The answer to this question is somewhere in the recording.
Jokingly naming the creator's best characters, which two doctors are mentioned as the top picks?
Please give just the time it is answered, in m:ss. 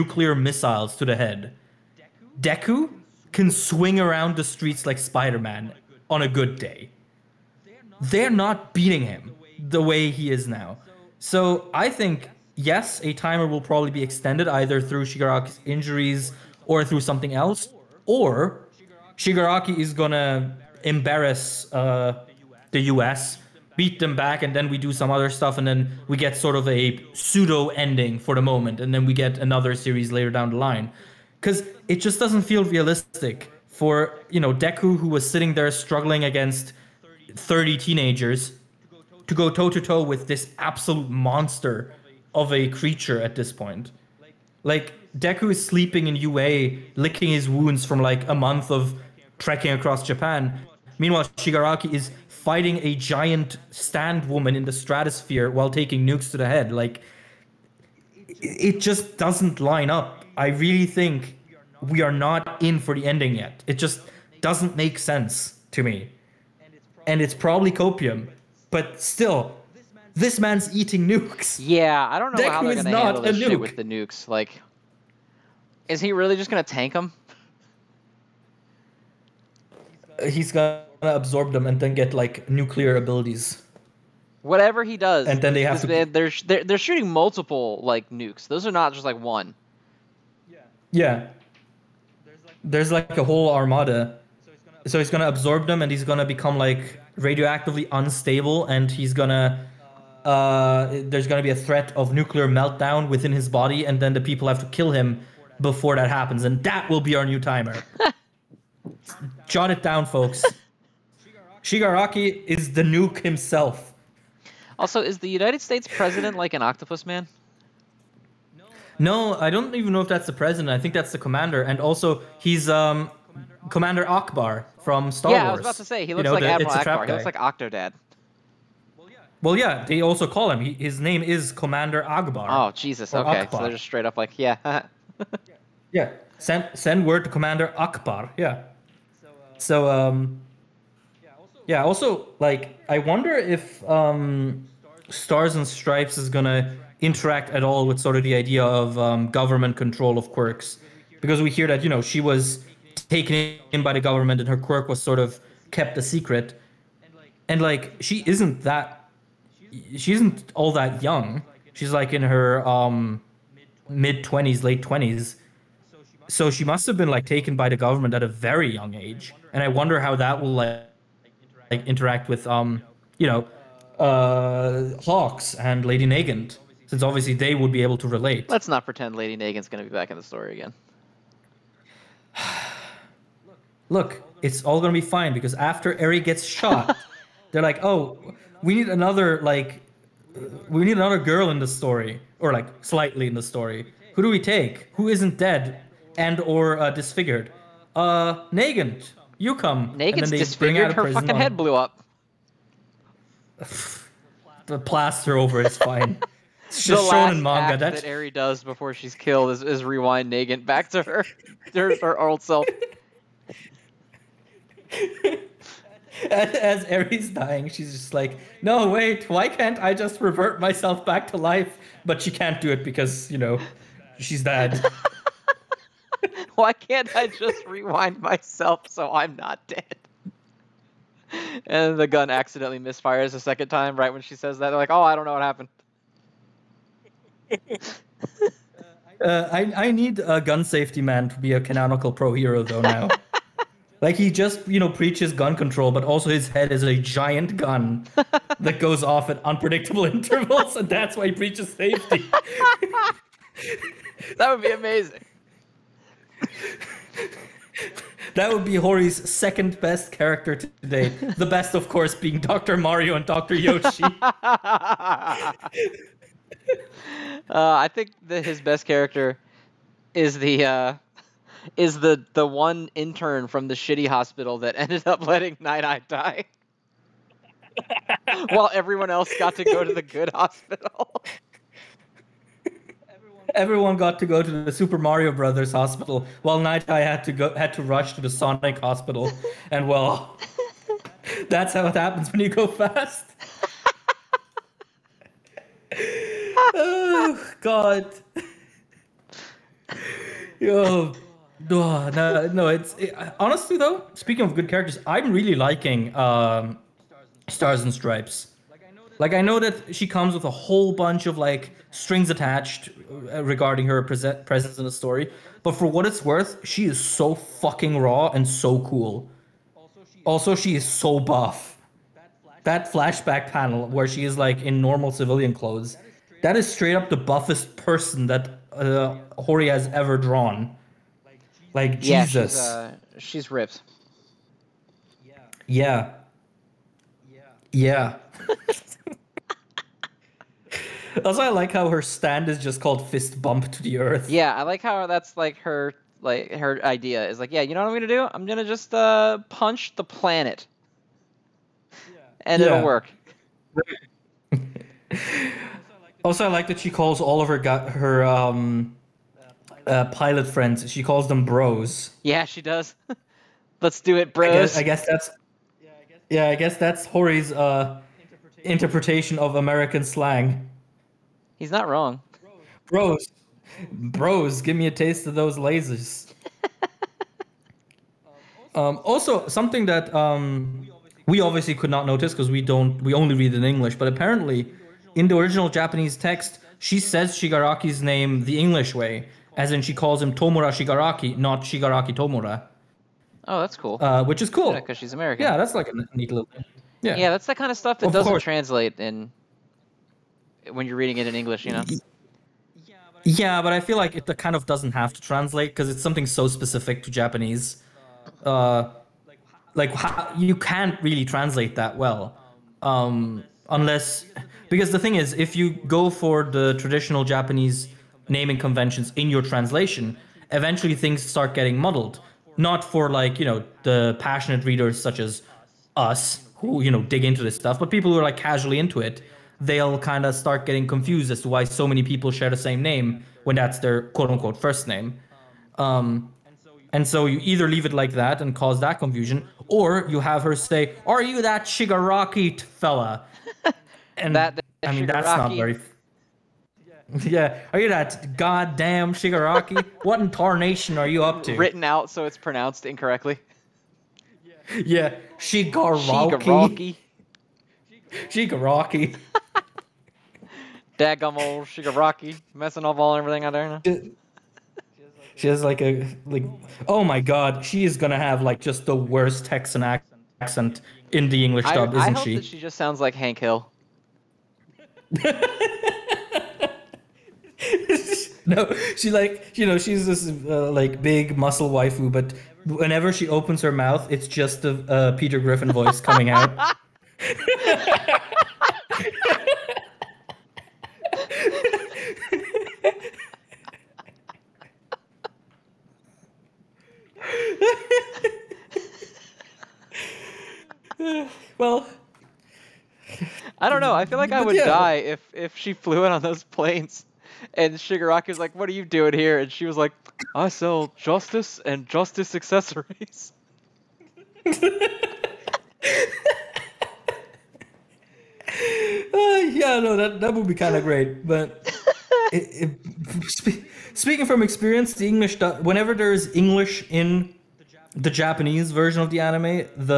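4:22.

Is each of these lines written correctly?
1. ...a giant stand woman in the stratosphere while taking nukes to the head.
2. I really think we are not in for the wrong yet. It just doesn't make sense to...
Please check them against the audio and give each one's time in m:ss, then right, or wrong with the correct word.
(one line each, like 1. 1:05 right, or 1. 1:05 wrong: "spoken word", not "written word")
1. 0:52 right
2. 1:00 wrong: "ending", not "wrong".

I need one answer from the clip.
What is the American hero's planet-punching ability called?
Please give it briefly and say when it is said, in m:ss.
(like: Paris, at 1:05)
Fist bump to the earth, at 5:43.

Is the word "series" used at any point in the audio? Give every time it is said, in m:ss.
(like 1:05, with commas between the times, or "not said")
0:29.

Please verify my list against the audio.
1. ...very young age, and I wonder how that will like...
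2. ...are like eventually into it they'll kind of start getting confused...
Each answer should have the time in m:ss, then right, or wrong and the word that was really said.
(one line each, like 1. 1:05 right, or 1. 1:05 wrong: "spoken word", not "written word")
1. 2:48 right
2. 7:08 wrong: "casually", not "eventually".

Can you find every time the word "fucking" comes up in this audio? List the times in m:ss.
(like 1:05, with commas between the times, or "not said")
3:21, 5:17.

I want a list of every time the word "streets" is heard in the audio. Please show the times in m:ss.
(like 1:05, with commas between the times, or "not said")
0:04.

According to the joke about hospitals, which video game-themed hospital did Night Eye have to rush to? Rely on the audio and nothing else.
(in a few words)
Sonic hospital.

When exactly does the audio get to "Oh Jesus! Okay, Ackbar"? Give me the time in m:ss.
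2:12.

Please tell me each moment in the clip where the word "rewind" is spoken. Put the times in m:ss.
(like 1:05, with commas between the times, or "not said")
3:29, 3:47.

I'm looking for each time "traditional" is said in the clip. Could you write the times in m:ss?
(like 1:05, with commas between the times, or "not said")
6:56.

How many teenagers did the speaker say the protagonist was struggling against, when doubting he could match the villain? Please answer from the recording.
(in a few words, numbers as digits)
30.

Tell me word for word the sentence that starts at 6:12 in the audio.
Bros, bros, give me a taste of those lasers.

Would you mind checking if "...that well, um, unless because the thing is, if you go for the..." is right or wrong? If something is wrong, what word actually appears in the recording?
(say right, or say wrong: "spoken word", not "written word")
right.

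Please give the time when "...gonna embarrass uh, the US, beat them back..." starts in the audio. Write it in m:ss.
0:19.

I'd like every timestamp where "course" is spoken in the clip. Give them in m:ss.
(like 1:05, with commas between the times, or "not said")
4:21, 6:38.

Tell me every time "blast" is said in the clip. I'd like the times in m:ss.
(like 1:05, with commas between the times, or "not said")
not said.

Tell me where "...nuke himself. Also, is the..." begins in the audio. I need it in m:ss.
1:52.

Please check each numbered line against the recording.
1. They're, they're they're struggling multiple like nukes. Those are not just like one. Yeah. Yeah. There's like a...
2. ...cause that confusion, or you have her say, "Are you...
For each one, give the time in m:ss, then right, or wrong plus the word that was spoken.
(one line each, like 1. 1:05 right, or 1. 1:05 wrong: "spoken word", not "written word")
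1. 1:25 wrong: "shooting", not "struggling"
2. 7:18 right.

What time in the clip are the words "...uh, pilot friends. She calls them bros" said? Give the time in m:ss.
5:59.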